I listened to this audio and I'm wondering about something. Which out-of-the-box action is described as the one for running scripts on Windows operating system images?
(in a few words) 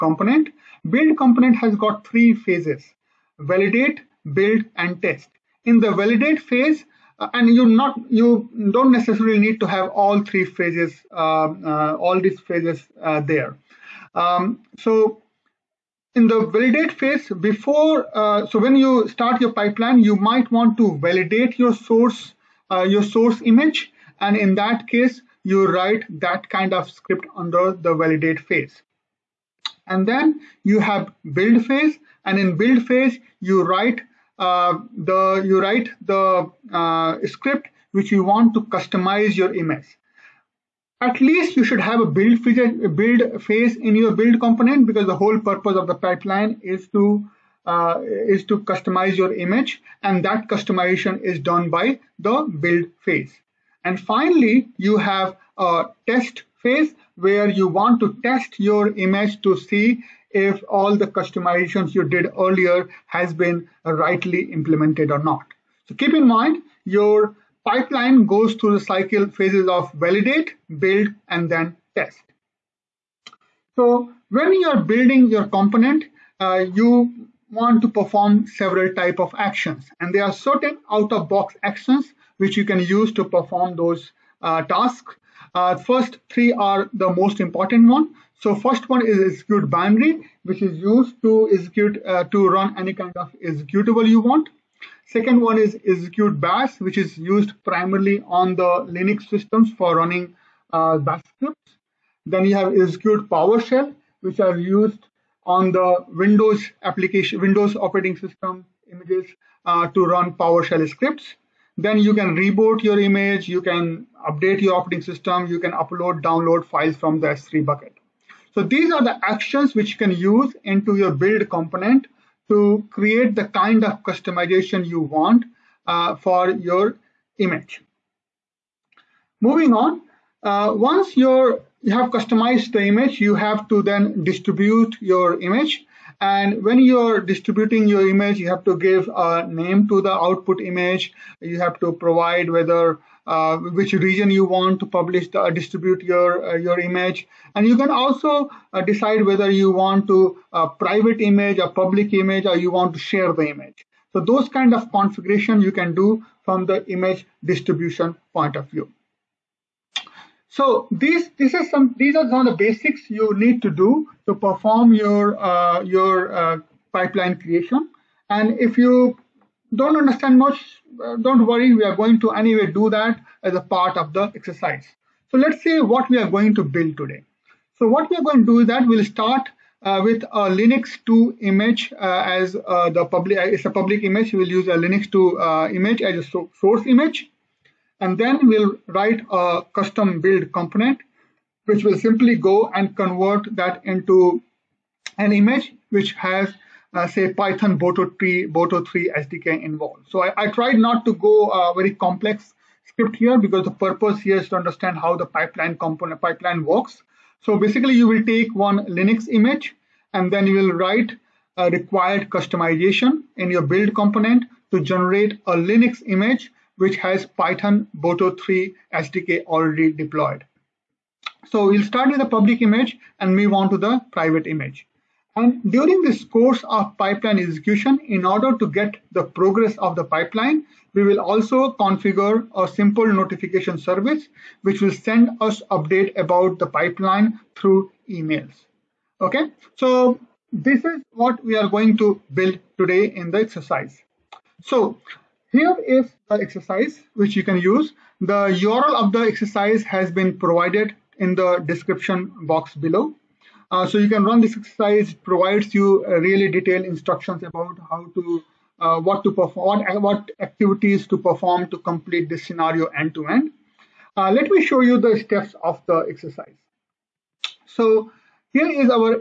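Execute PowerShell.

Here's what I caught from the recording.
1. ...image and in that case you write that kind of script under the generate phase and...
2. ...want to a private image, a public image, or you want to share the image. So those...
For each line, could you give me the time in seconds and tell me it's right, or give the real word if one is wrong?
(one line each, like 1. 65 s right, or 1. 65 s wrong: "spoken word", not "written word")
1. 23 s wrong: "validate", not "generate"
2. 149 s right.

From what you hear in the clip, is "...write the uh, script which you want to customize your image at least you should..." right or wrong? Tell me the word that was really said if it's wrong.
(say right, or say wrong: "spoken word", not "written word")
right.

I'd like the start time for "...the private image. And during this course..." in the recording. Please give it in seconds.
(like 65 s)
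223 s.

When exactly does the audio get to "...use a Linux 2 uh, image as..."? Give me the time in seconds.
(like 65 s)
184 s.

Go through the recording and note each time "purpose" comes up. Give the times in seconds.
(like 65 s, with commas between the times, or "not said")
45 s, 203 s.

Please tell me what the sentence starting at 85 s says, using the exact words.
Uh, first three are the most important one.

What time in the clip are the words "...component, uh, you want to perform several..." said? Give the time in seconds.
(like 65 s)
75 s.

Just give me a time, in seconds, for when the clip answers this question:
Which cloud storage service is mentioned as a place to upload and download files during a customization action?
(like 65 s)
117 s.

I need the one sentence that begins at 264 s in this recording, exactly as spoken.
Uh, let me show you the steps of the exercise.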